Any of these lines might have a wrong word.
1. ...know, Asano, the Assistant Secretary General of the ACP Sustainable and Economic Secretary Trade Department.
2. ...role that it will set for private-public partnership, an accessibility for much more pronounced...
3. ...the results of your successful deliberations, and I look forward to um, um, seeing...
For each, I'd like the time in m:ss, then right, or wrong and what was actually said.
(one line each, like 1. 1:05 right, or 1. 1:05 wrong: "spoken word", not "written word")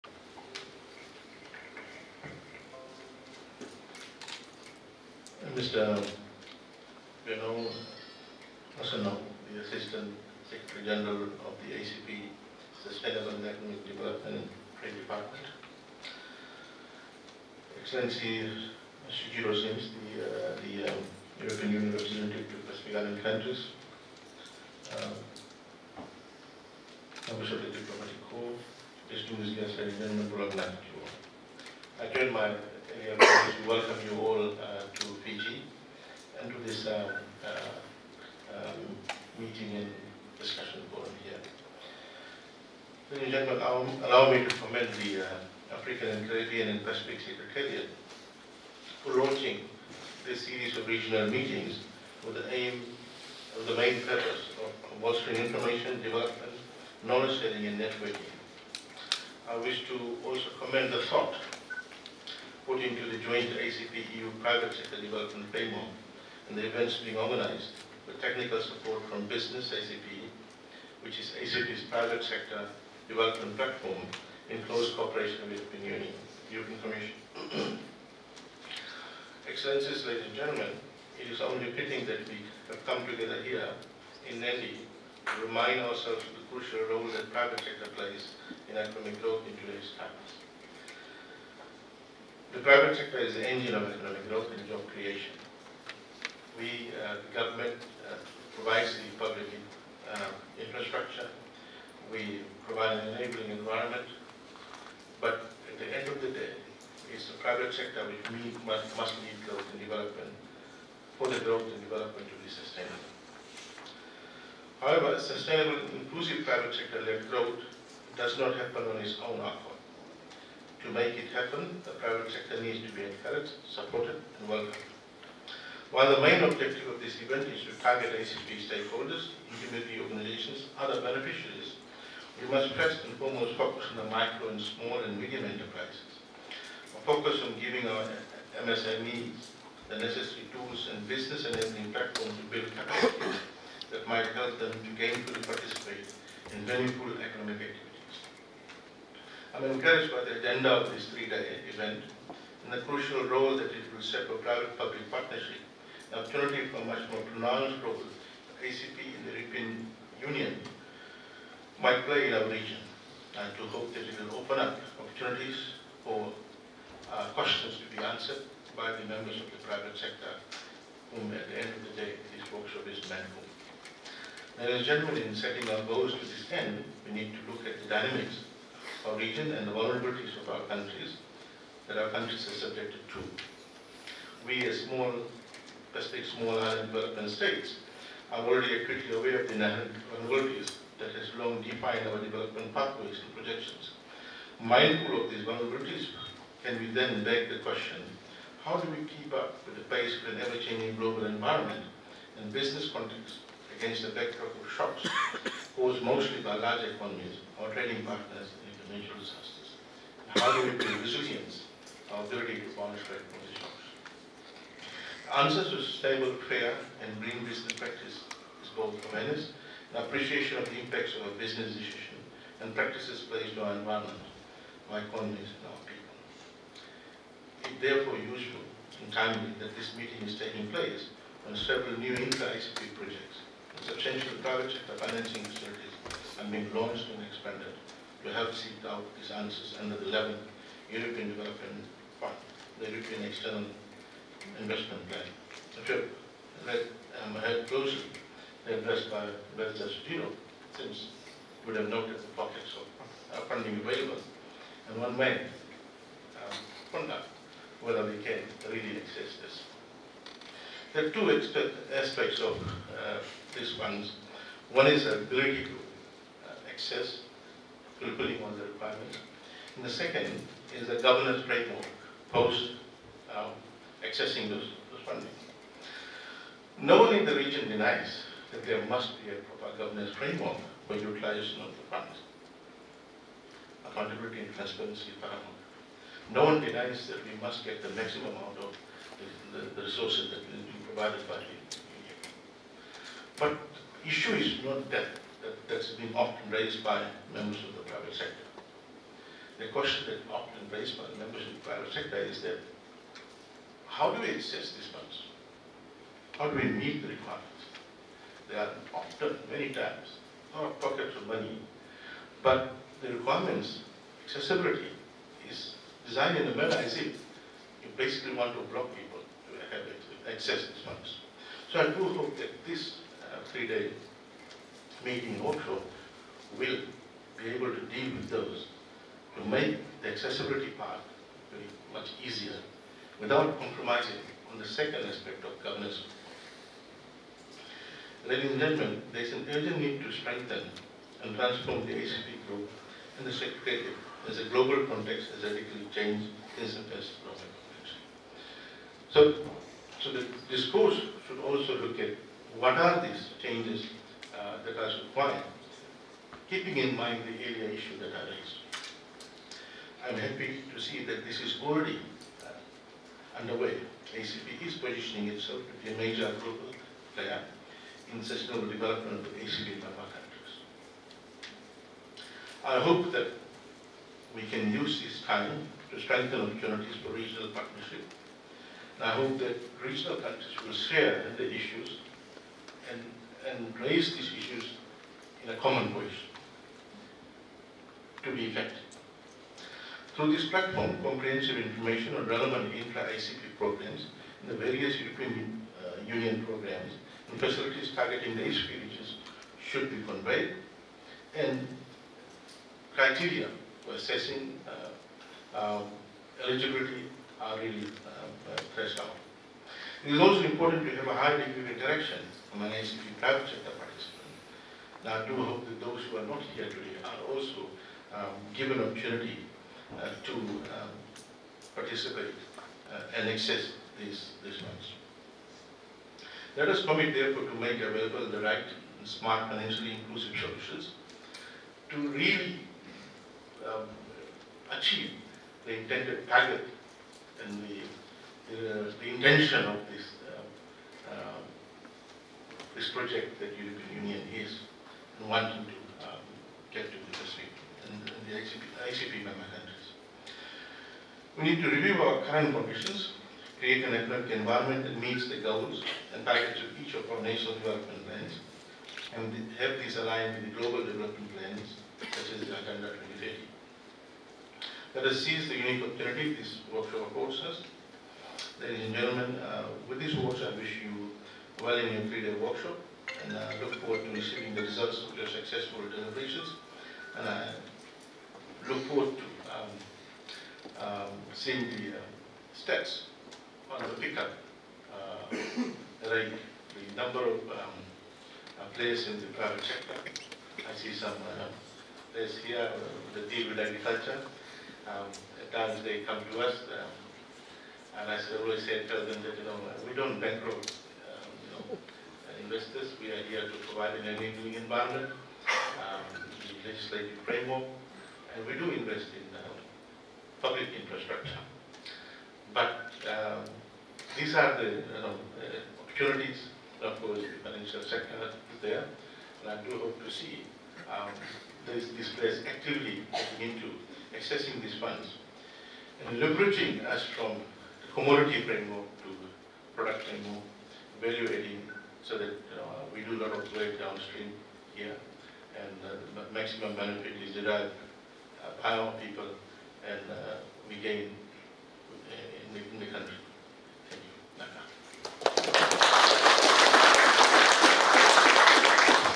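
1. 0:07 wrong: "Development", not "Secretary"
2. 2:33 wrong: "opportunity", not "accessibility"
3. 7:54 right.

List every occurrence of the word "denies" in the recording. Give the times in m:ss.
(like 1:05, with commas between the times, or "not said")
4:37, 4:46.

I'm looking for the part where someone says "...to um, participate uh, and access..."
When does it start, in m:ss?
7:00.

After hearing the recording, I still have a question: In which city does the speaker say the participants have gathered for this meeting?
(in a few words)
Delhi.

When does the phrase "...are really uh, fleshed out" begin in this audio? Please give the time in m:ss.
6:47.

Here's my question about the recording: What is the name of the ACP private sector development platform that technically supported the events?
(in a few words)
Business ACP.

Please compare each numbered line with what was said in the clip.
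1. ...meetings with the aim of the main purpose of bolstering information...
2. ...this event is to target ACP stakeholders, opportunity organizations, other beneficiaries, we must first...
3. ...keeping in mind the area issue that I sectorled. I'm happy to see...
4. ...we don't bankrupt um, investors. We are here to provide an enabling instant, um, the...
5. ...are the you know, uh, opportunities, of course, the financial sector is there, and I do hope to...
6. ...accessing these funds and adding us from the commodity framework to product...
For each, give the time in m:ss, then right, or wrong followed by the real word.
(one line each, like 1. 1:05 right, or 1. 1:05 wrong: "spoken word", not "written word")
1. 0:51 right
2. 2:07 wrong: "community", not "opportunity"
3. 5:56 wrong: "raised", not "sectorled"
4. 8:19 wrong: "environment", not "instant"
5. 8:34 right
6. 8:44 wrong: "leveraging", not "adding".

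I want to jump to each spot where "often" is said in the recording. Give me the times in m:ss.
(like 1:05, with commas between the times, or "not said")
4:56, 5:00, 5:08.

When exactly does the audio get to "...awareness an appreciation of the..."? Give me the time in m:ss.
3:39.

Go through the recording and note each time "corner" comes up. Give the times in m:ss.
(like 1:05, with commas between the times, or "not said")
not said.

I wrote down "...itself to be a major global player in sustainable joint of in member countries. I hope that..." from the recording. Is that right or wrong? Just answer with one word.
wrong.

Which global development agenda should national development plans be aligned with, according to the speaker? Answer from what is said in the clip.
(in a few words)
Agenda 2030.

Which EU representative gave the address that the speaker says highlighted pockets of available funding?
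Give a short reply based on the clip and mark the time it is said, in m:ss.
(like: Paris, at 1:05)
Mr. Sujiro, at 4:09.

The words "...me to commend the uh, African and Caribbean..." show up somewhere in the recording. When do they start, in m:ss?
0:44.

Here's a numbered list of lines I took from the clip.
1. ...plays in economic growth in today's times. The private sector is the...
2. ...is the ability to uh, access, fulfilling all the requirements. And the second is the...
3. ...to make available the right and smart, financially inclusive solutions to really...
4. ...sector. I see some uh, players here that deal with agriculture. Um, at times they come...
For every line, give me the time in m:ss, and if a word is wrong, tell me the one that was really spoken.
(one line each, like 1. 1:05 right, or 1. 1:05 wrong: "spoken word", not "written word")
1. 1:27 right
2. 4:24 right
3. 7:07 right
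4. 8:09 right.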